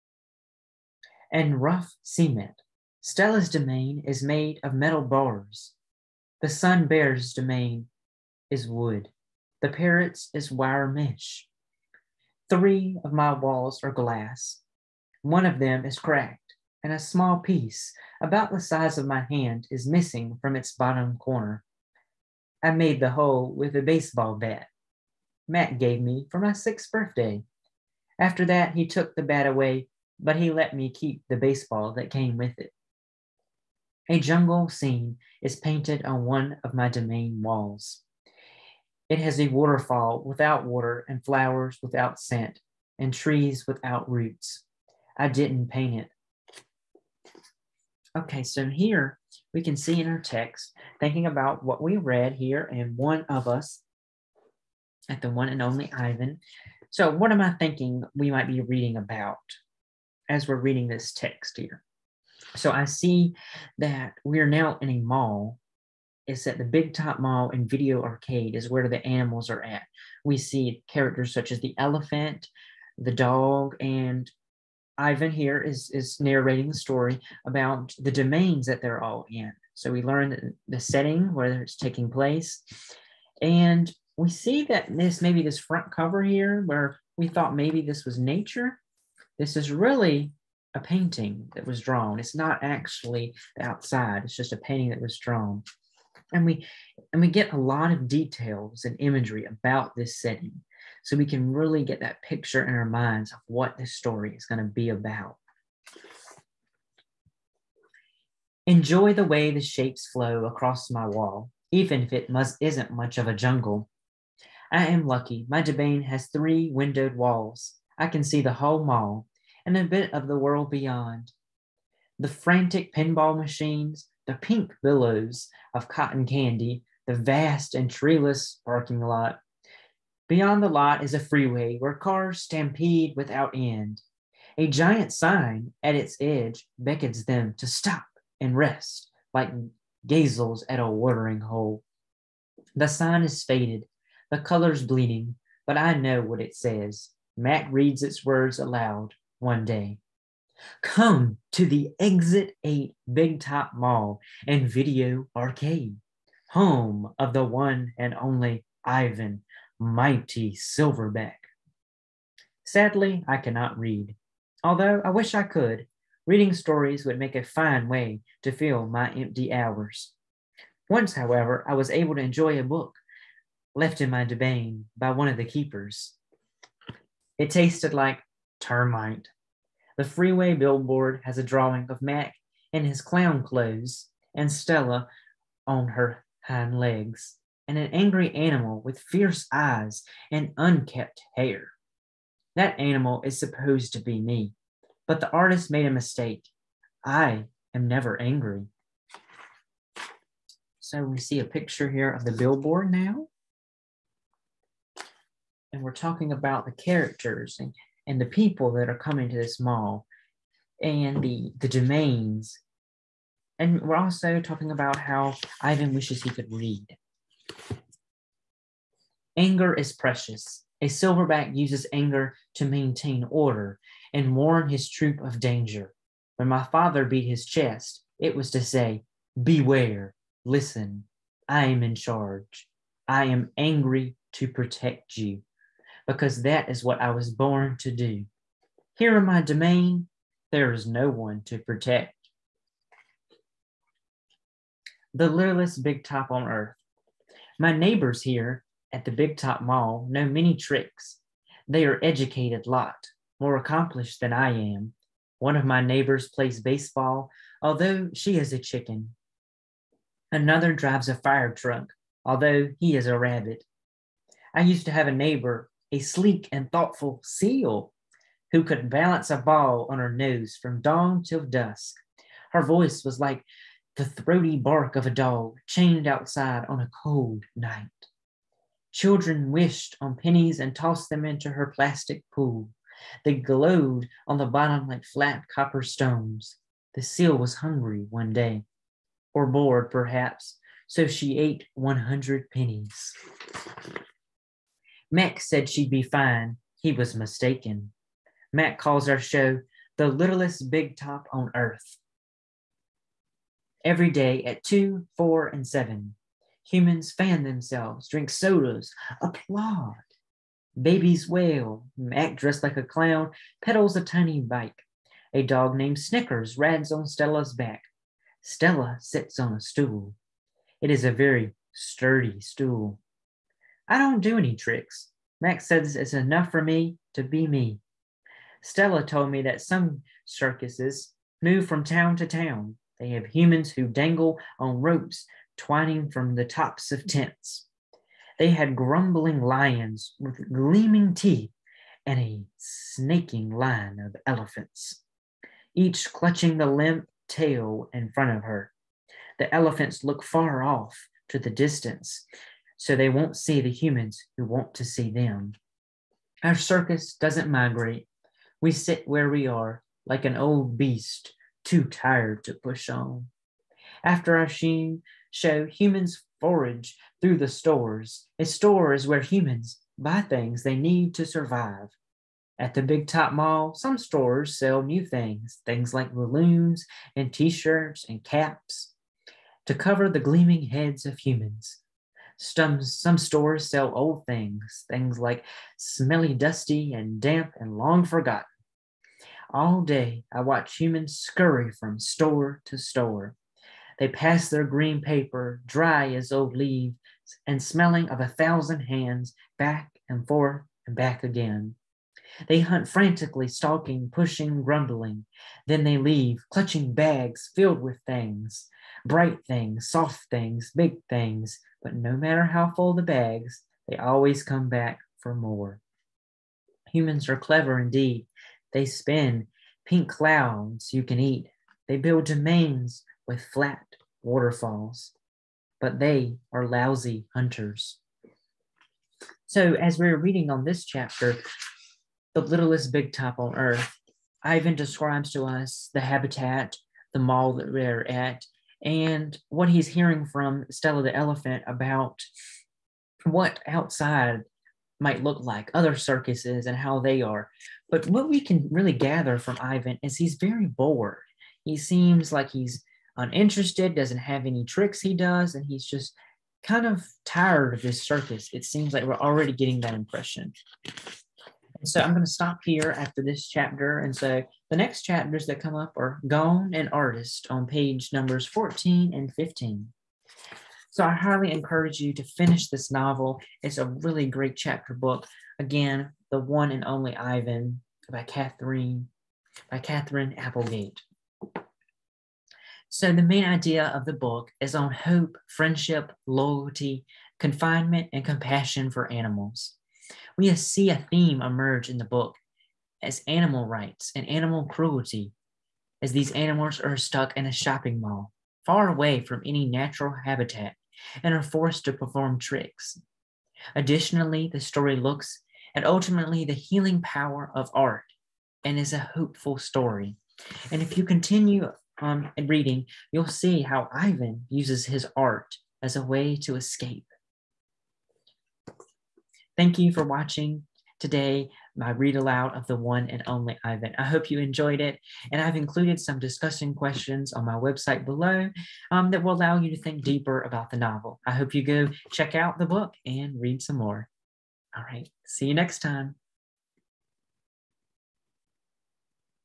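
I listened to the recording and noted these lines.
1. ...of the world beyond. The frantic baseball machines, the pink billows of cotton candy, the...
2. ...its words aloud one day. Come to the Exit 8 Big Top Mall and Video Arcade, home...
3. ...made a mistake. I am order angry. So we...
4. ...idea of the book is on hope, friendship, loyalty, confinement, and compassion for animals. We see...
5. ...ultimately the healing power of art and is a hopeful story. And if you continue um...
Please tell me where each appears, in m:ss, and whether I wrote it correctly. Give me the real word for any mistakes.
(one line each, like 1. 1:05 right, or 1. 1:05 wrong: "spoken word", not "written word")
1. 2:00 wrong: "pinball", not "baseball"
2. 2:28 right
3. 3:15 wrong: "never", not "order"
4. 8:03 right
5. 8:25 right.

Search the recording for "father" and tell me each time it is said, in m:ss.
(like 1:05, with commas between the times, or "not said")
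3:46.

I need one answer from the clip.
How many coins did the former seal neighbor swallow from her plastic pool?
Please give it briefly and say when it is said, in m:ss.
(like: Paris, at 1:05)
100, at 4:51.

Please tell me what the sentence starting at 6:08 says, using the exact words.
A store is where humans buy things they need to survive.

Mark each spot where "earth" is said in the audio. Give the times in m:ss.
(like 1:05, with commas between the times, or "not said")
4:06, 5:01, 7:13.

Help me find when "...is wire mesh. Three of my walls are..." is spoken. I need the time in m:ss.
0:10.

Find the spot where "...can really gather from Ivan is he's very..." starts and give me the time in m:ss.
7:28.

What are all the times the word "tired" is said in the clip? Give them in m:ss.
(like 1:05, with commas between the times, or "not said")
6:01, 7:37.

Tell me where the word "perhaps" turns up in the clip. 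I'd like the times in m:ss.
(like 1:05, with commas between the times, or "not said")
4:49.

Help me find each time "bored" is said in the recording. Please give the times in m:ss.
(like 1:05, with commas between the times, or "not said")
4:49, 7:30.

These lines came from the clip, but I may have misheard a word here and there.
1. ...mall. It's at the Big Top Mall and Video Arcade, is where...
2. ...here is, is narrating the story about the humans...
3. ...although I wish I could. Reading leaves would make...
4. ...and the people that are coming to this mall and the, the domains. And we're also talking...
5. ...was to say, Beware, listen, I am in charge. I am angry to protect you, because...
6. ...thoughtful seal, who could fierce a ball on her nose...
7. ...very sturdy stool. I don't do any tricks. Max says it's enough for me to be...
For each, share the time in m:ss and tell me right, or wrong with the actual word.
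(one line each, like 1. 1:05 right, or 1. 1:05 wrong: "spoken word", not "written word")
1. 1:04 right
2. 1:15 wrong: "domains", not "humans"
3. 2:44 wrong: "stories", not "leaves"
4. 3:28 right
5. 3:48 right
6. 4:26 wrong: "balance", not "fierce"
7. 5:21 right.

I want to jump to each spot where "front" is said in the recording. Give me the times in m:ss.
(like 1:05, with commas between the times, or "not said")
1:25, 5:48.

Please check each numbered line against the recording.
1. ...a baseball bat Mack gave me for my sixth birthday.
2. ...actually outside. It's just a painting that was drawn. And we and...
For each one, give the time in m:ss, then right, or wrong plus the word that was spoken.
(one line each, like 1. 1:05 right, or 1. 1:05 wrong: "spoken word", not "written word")
1. 0:23 right
2. 1:32 right.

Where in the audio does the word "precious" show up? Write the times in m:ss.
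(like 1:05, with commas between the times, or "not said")
3:39.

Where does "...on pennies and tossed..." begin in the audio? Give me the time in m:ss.
4:39.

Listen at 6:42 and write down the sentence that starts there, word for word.
They hunt frantically, stalking, pushing, grumbling.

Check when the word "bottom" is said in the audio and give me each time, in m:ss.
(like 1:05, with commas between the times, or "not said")
0:20, 4:44.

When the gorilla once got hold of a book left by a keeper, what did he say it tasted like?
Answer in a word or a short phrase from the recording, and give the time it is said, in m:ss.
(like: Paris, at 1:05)
termite, at 2:58.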